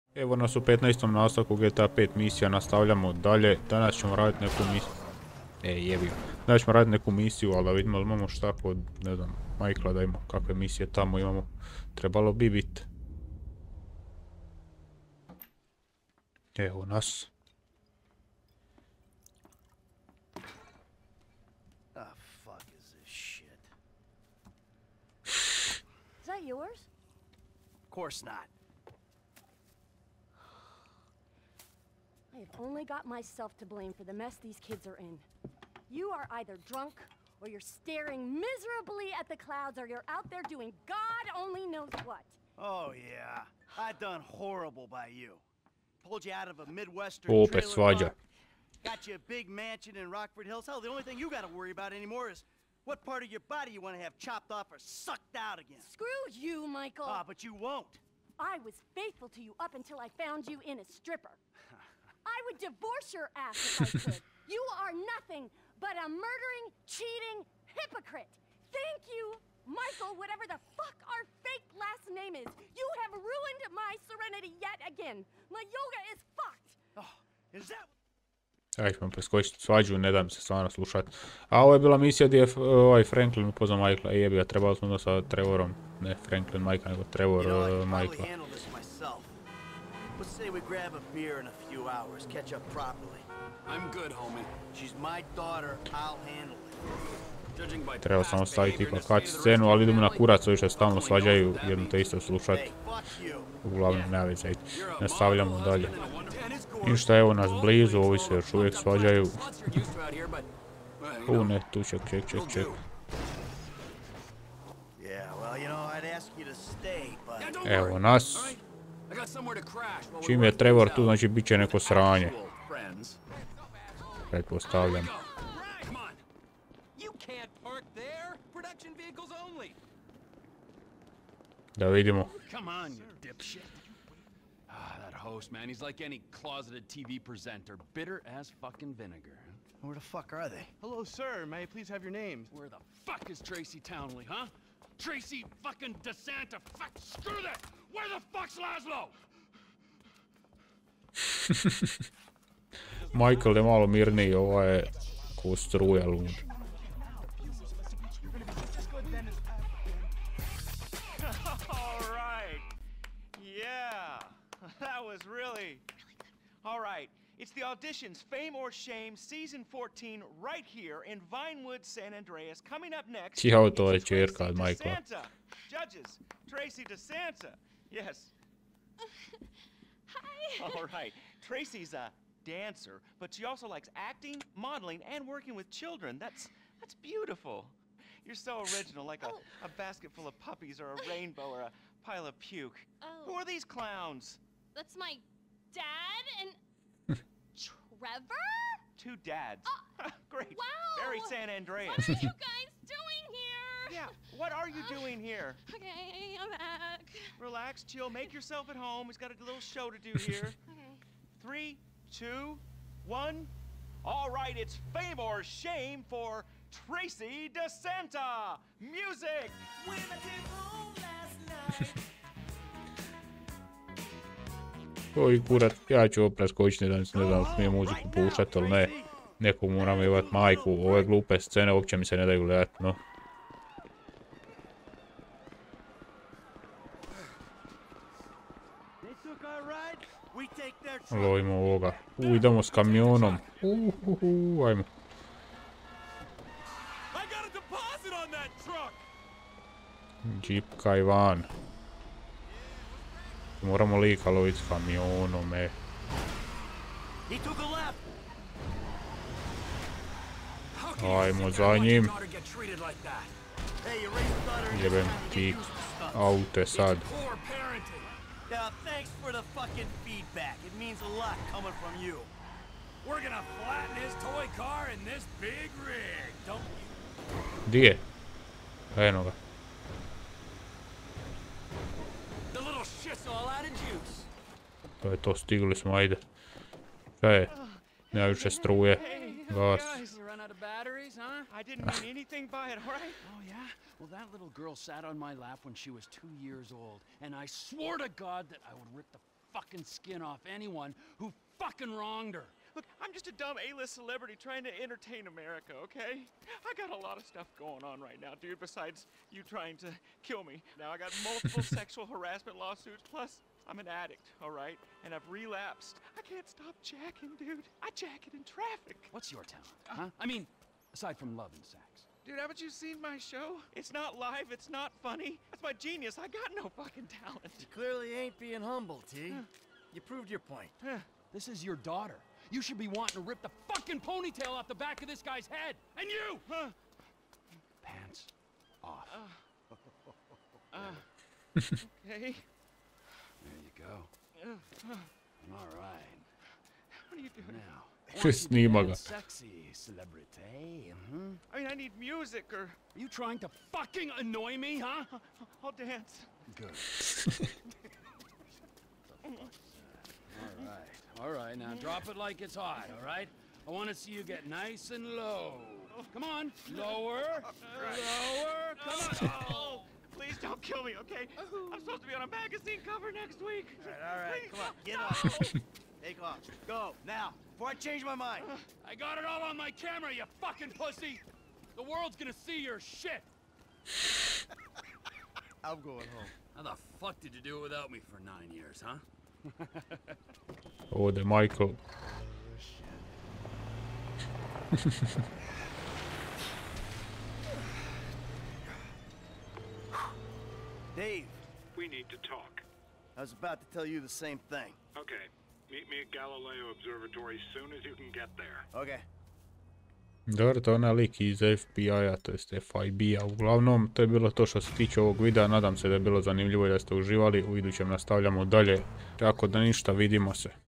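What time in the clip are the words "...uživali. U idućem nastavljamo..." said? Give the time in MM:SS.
06:56.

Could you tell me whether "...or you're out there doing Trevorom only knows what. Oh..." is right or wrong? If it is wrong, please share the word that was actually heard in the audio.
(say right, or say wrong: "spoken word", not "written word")
wrong: "God", not "Trevorom".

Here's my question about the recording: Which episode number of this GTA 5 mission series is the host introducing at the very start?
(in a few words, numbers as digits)
15.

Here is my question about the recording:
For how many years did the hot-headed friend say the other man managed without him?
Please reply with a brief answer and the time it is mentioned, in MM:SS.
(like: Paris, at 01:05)
9, at 06:28.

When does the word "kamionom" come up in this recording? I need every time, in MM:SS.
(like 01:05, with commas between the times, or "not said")
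04:02, 04:14.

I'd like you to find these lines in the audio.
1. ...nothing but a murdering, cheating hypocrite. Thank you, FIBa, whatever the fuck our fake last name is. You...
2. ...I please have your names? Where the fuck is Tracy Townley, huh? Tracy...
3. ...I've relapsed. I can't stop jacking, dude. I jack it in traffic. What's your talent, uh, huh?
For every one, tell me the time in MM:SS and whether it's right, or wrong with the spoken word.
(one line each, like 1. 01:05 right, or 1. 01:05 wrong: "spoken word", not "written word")
1. 01:05 wrong: "Michael", not "FIBa"
2. 02:21 right
3. 05:15 right.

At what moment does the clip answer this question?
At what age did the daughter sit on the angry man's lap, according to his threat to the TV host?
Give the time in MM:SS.
04:56.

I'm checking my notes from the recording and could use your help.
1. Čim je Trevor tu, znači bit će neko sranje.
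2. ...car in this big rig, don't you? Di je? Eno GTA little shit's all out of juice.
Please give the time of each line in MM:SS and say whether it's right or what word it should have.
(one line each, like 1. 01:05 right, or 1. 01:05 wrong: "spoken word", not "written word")
1. 02:00 right
2. 04:34 wrong: "The", not "GTA".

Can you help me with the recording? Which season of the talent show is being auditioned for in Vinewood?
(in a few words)
14.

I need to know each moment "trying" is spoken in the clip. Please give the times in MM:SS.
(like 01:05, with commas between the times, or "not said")
05:04, 05:09, 05:53.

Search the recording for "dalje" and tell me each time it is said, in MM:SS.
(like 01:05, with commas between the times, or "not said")
00:03, 01:45, 06:58.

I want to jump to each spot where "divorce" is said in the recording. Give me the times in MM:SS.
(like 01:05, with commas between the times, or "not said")
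01:02.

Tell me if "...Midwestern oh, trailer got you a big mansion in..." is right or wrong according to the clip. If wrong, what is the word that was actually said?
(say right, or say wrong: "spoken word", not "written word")
right.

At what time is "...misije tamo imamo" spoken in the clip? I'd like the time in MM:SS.
00:10.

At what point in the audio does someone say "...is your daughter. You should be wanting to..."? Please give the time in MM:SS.
05:31.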